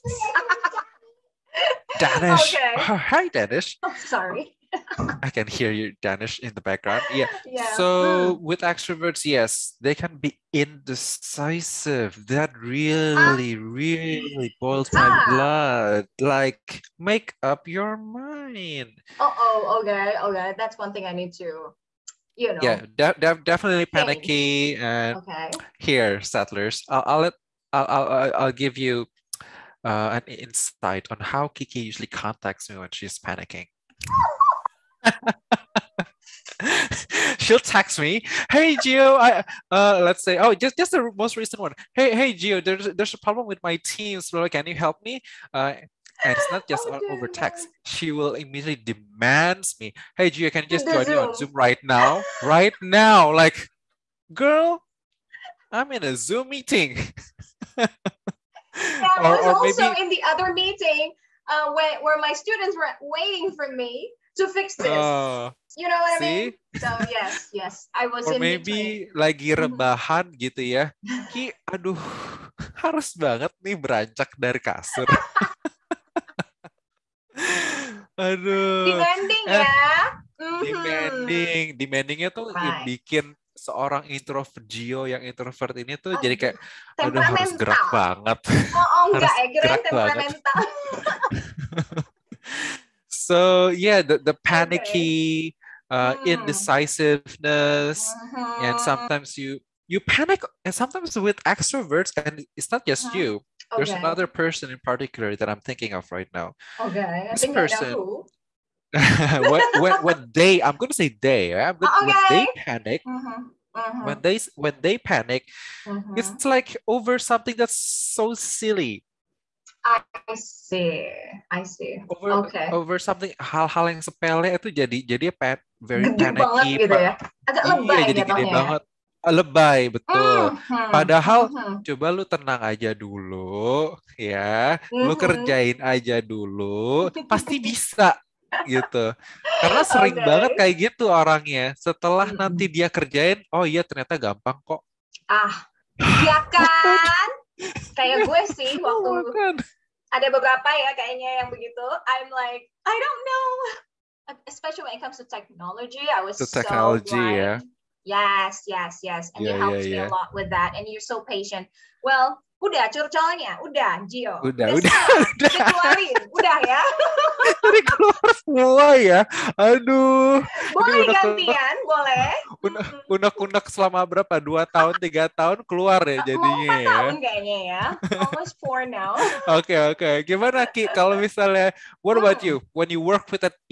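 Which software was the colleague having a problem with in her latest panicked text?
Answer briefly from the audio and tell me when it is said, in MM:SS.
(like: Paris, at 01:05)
Teams, at 00:43.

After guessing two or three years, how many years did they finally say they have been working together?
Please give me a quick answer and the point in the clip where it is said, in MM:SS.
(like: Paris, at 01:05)
4, at 02:58.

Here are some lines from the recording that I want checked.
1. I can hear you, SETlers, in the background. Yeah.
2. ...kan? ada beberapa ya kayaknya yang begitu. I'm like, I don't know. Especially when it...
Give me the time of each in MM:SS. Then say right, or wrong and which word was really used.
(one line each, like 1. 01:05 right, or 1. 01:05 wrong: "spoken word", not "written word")
1. 00:05 wrong: "Danish", not "SETlers"
2. 02:29 right.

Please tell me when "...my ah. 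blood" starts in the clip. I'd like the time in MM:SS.
00:14.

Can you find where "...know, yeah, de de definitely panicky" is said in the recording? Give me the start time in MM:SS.
00:22.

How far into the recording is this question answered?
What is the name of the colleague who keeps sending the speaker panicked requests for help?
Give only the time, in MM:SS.
00:31.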